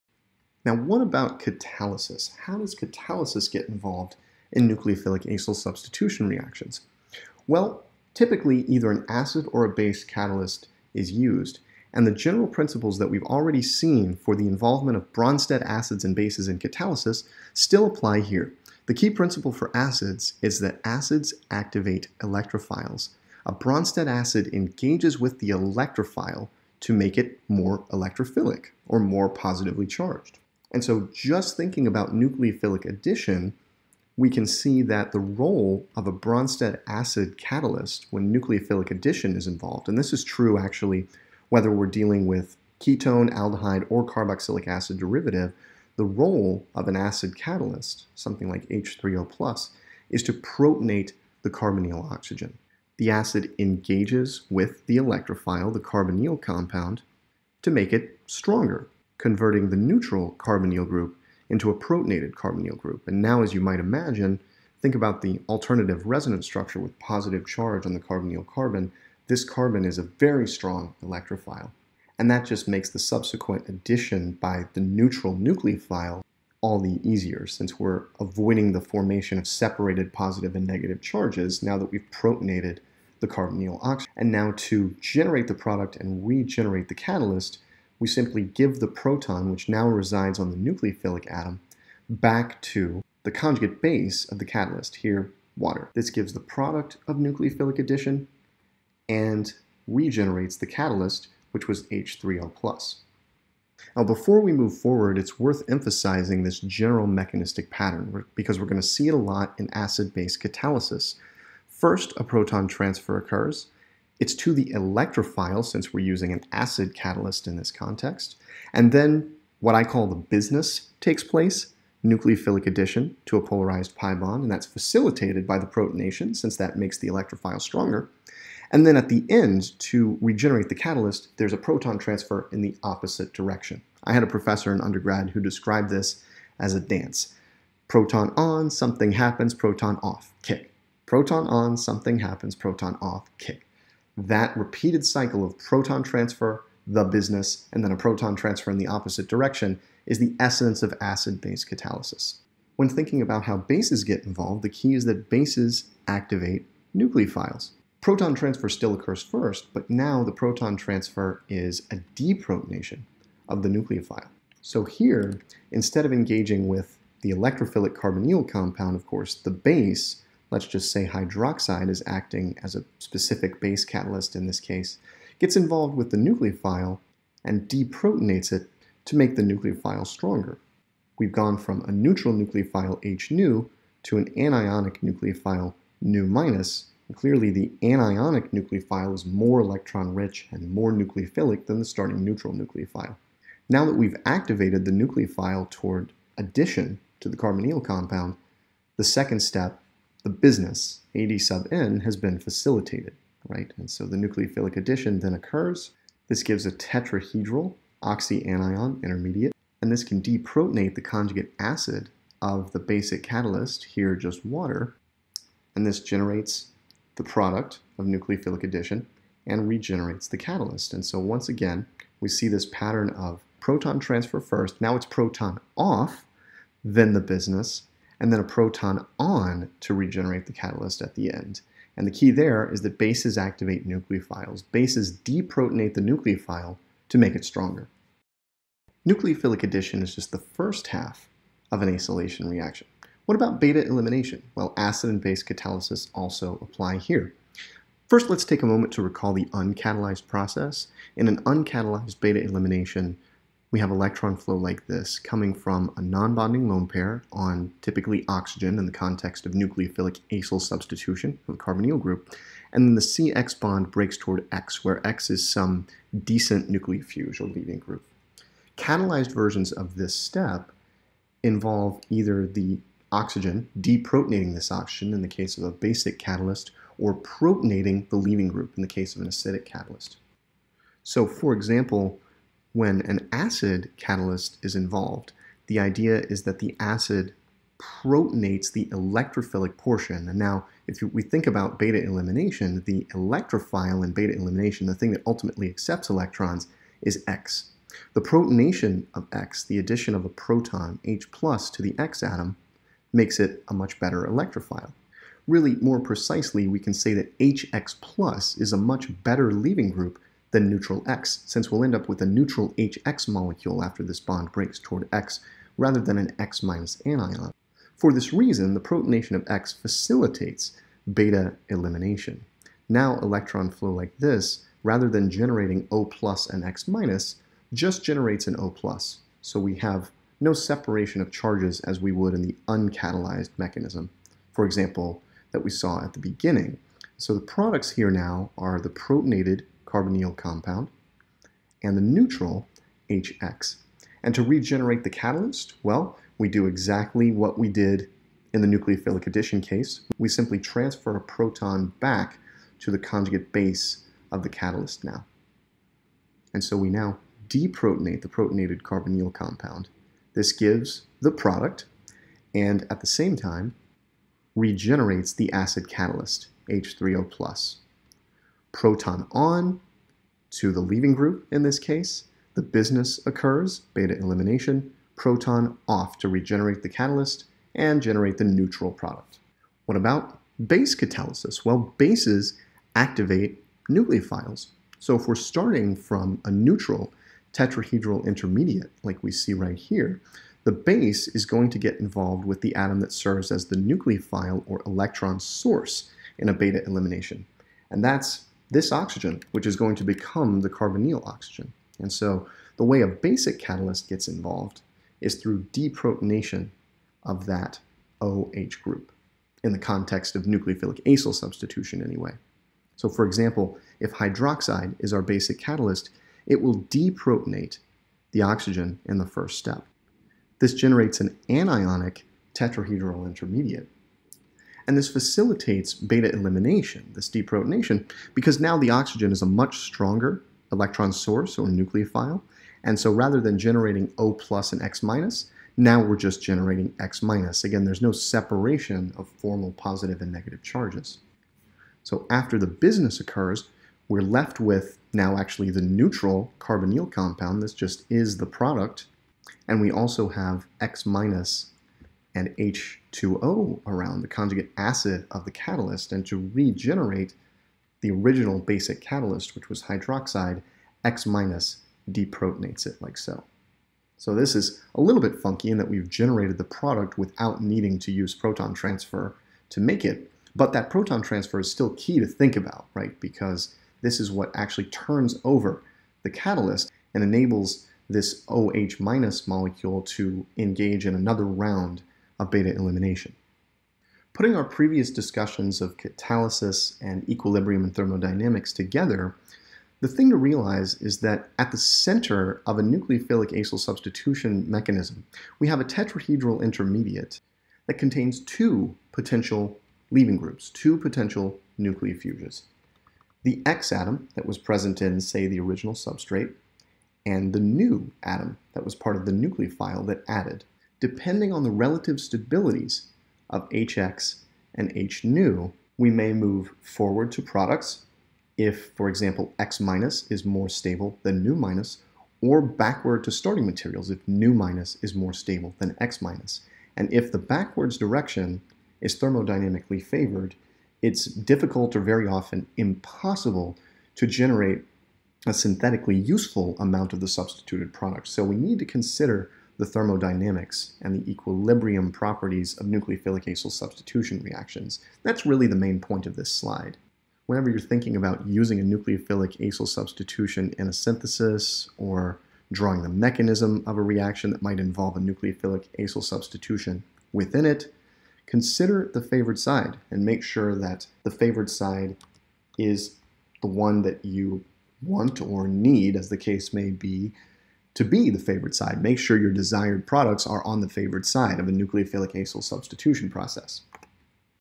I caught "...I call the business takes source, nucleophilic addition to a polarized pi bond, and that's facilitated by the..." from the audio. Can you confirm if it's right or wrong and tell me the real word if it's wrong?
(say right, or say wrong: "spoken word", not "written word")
wrong: "place", not "source".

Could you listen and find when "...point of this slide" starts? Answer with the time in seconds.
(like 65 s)
545 s.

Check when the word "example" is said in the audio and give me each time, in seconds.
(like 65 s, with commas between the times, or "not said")
281 s, 334 s, 413 s, 519 s.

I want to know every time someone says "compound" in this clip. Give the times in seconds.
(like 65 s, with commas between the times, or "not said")
56 s, 168 s, 197 s, 340 s, 359 s, 447 s.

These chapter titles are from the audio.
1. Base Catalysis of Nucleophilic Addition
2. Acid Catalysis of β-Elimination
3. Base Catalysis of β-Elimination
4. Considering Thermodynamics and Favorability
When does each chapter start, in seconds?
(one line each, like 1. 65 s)
1. 152 s
2. 238 s
3. 379 s
4. 483 s.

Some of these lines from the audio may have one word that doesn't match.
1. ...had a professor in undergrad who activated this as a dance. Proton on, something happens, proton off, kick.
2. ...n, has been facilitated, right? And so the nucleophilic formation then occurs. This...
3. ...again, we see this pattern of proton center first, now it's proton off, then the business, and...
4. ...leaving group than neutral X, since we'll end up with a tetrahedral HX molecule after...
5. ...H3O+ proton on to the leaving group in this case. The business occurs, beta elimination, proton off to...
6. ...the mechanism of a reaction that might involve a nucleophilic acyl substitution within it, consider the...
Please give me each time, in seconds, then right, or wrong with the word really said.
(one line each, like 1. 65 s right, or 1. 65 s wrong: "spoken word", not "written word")
1. 134 s wrong: "described", not "activated"
2. 201 s wrong: "addition", not "formation"
3. 221 s wrong: "transfer", not "center"
4. 309 s wrong: "neutral", not "tetrahedral"
5. 366 s right
6. 553 s right.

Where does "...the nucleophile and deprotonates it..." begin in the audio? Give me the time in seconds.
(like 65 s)
176 s.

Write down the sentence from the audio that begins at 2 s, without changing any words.
How does catalysis get involved in nucleophilic acyl substitution reactions?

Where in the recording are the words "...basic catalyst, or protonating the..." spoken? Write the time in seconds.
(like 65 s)
275 s.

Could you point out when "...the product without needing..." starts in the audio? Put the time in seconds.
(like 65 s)
466 s.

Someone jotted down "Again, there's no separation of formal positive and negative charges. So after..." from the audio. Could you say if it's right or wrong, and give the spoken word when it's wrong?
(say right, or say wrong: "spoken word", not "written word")
right.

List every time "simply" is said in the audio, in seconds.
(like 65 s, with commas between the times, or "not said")
88 s, 350 s.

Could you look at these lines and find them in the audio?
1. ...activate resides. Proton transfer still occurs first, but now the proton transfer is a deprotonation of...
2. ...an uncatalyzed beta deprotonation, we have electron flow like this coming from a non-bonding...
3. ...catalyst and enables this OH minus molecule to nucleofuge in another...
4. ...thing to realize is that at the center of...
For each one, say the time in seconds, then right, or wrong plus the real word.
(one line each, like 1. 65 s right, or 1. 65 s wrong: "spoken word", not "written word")
1. 156 s wrong: "nucleophiles", not "resides"
2. 251 s wrong: "elimination", not "deprotonation"
3. 476 s wrong: "engage", not "nucleofuge"
4. 490 s right.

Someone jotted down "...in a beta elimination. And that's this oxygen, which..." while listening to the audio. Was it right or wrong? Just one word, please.
right.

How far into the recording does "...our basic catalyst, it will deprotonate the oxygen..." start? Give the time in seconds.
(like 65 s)
415 s.